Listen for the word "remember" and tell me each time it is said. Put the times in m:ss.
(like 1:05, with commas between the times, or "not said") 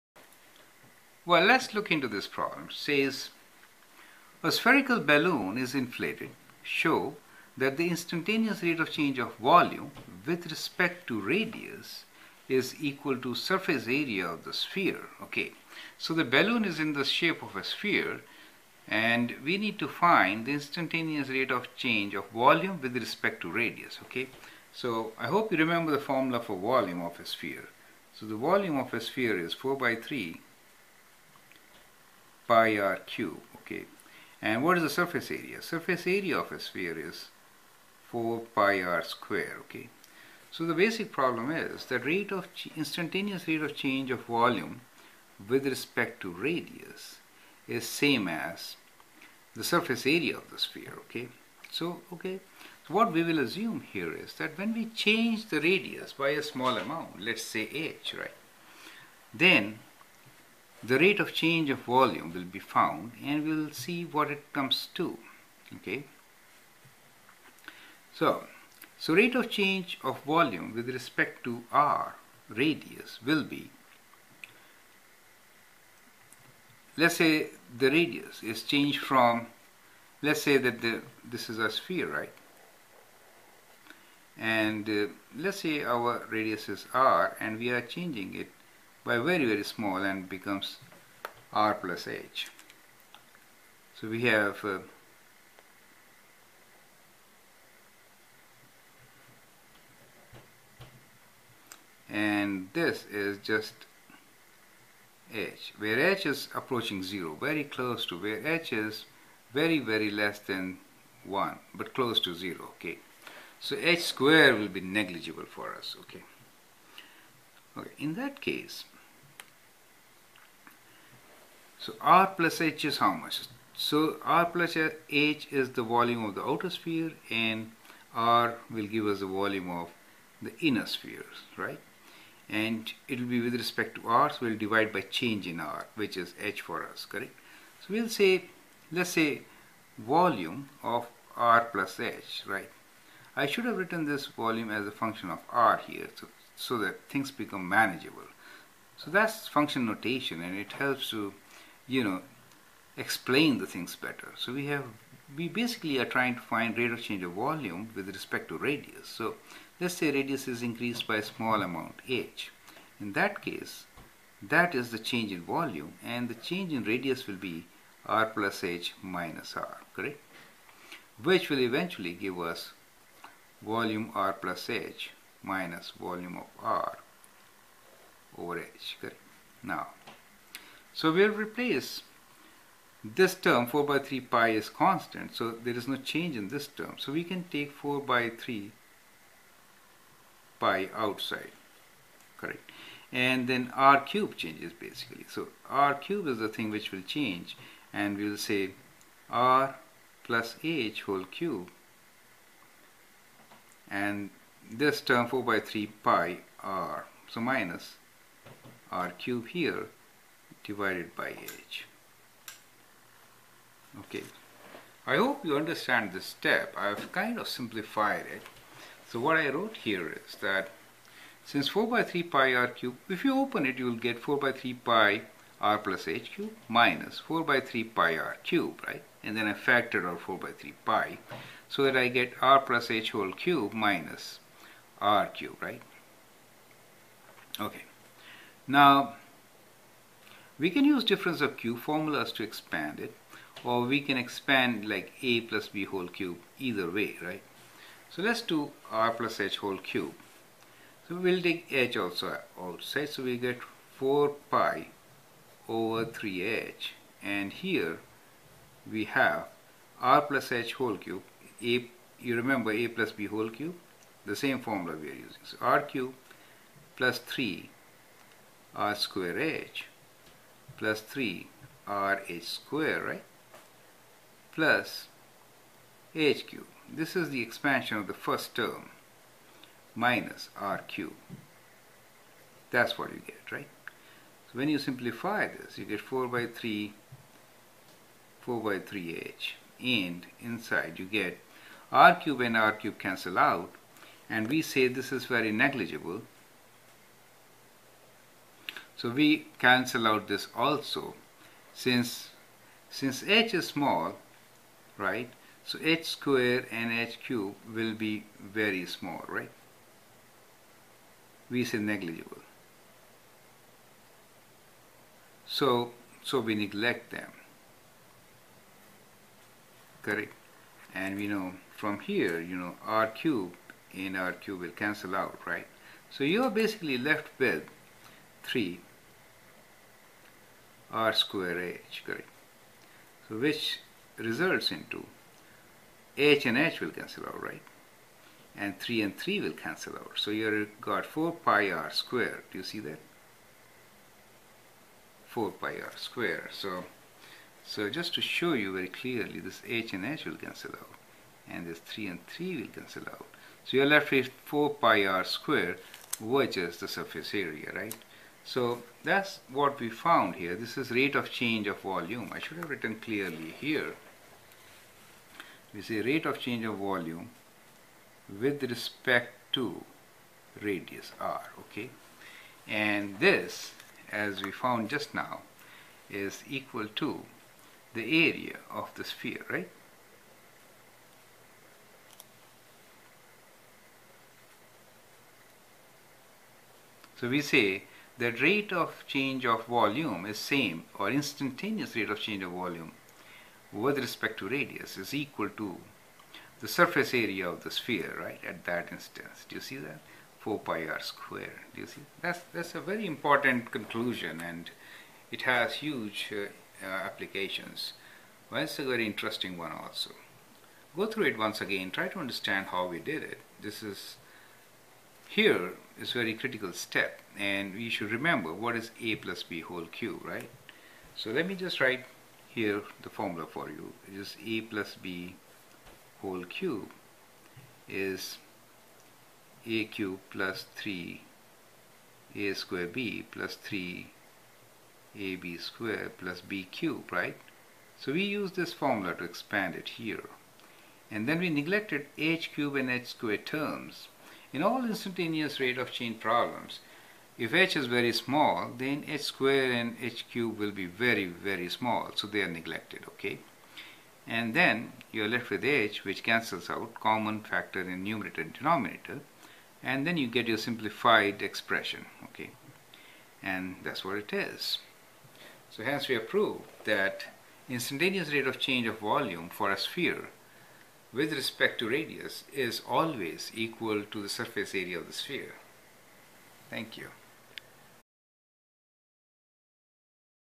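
0:25, 4:22, 6:58.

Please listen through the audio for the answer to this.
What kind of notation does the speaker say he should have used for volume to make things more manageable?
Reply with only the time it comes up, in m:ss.
2:29.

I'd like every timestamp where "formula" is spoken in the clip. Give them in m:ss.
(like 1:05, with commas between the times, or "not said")
0:25, 4:01, 4:24, 7:03, 7:18.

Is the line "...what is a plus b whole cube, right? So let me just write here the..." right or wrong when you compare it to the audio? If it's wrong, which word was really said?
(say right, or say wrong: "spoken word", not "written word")
right.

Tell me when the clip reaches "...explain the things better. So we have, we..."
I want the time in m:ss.
2:32.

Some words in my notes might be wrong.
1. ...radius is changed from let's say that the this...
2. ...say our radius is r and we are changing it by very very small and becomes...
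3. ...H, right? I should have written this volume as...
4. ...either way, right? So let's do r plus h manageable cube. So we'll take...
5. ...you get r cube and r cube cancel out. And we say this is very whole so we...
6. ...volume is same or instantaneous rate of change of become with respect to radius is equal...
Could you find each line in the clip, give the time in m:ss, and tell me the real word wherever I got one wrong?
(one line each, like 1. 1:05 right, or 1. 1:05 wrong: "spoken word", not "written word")
1. 1:17 right
2. 1:25 right
3. 2:21 right
4. 4:06 wrong: "whole", not "manageable"
5. 4:50 wrong: "negligible", not "whole"
6. 6:29 wrong: "volume", not "become".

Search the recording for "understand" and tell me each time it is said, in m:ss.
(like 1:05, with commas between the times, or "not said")
3:35, 6:52.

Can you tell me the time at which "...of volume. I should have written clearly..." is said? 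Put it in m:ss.
6:01.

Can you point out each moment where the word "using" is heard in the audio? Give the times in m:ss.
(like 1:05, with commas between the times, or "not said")
4:25.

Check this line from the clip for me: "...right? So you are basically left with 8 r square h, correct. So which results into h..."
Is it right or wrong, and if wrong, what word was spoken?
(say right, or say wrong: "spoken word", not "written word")
wrong: "3", not "8".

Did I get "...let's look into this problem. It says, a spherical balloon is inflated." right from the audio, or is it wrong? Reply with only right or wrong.
right.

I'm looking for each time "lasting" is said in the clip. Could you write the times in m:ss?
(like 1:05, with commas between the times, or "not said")
not said.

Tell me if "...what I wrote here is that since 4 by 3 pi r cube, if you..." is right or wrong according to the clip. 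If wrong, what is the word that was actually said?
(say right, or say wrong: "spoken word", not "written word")
right.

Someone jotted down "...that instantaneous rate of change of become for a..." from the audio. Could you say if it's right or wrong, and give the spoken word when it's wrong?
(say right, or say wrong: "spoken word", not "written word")
wrong: "volume", not "become".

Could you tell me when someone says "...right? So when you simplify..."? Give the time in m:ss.
4:43.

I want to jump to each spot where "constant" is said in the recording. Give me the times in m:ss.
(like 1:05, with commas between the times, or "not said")
3:04.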